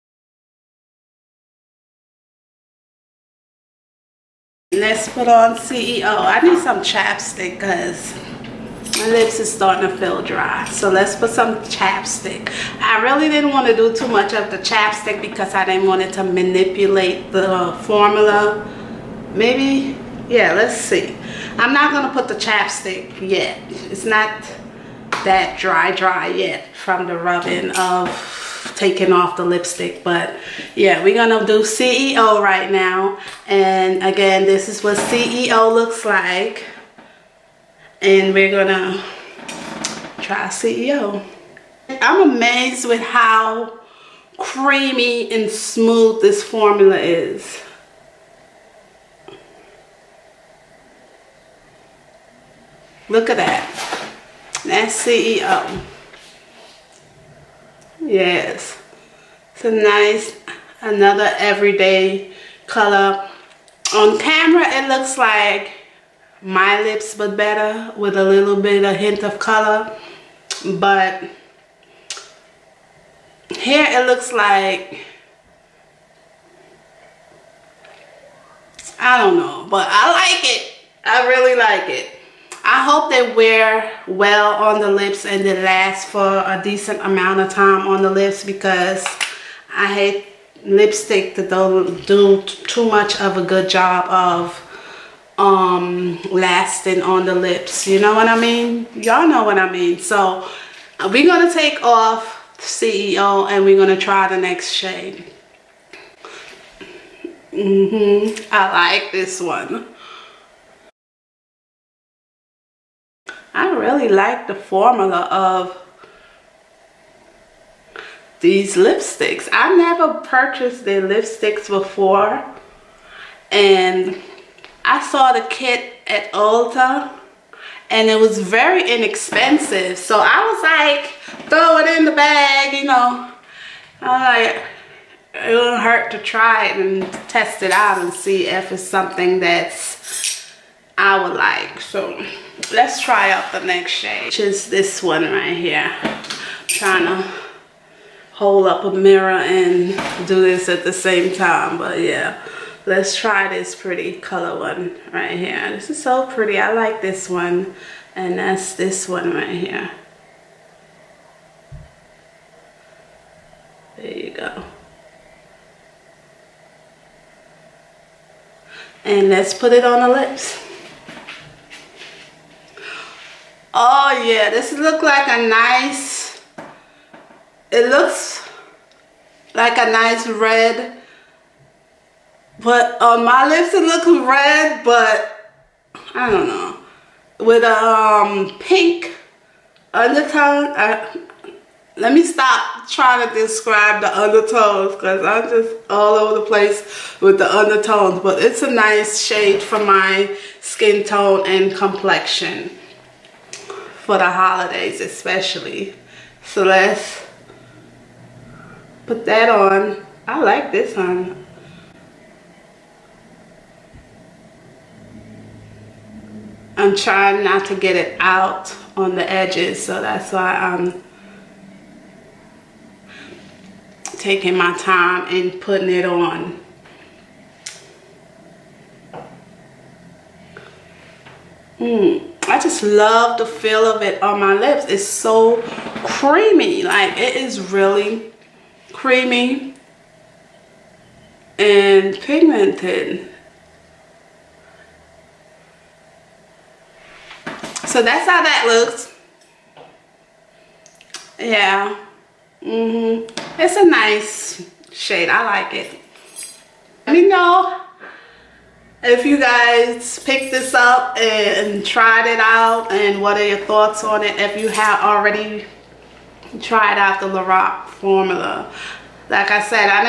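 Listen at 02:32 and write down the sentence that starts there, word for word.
Let's try this pretty color one right here.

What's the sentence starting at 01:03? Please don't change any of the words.
On camera, it looks like my lips, but better with a little bit of hint of color.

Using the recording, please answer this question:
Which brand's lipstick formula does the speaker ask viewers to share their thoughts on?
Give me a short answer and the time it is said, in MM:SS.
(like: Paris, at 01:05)
Lorac, at 04:27.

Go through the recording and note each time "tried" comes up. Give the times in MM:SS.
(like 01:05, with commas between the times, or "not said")
04:21, 04:26.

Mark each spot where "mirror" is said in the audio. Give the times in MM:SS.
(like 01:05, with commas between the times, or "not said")
02:28.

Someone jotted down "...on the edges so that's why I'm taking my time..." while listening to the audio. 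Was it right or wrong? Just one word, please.
right.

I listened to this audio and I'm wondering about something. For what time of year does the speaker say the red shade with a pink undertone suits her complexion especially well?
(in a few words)
The holidays.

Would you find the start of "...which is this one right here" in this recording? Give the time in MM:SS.
02:24.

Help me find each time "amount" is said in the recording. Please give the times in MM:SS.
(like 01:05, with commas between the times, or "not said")
01:27.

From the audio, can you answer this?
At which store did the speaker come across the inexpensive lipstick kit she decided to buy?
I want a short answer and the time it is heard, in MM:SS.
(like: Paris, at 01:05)
Ulta, at 02:06.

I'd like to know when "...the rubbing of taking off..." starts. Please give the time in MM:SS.
00:27.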